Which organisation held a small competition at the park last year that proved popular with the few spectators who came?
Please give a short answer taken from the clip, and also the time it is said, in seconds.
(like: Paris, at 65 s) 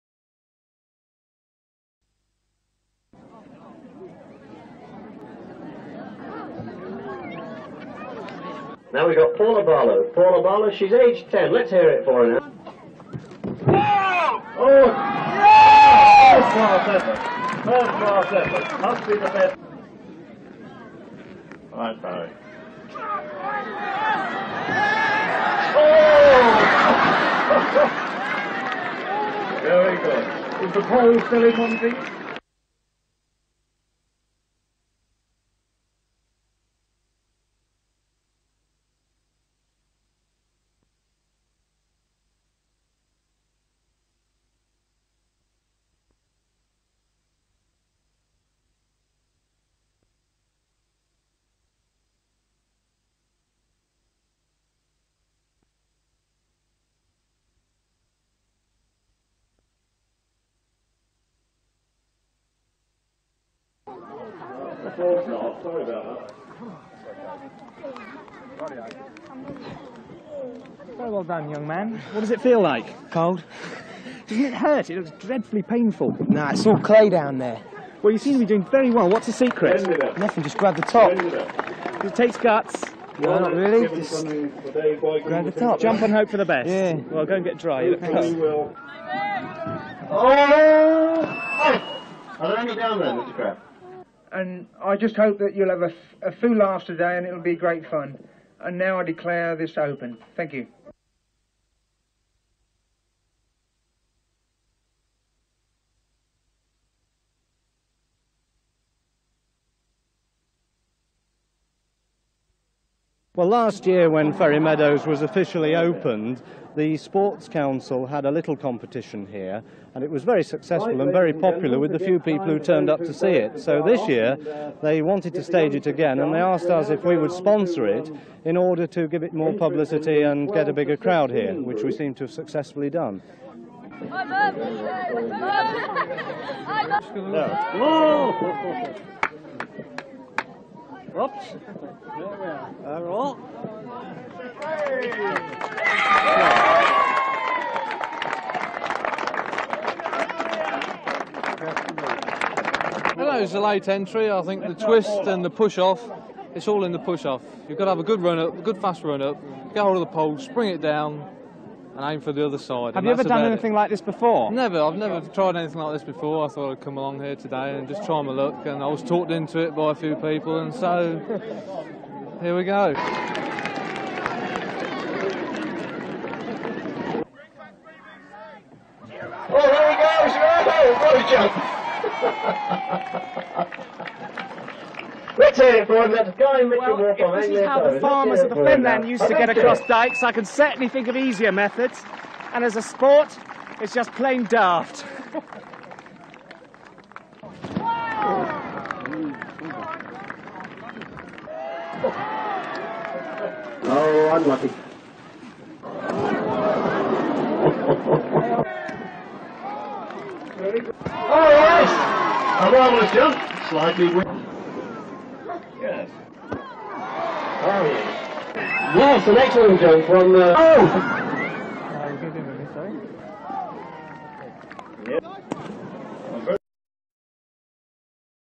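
The Sports Council, at 116 s.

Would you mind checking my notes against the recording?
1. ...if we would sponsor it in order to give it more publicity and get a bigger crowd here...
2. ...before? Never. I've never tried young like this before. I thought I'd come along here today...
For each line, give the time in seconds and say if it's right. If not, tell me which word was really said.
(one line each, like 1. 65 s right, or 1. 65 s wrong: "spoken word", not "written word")
1. 126 s right
2. 164 s wrong: "anything", not "young".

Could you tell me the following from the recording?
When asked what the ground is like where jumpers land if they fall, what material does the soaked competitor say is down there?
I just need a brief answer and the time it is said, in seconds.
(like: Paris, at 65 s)
Clay, at 76 s.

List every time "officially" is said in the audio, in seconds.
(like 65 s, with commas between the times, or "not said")
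115 s.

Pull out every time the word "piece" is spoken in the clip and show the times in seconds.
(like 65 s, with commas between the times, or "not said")
31 s.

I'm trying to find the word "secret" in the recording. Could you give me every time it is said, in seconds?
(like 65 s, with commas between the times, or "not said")
79 s.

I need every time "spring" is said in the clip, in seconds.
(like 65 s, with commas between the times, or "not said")
160 s.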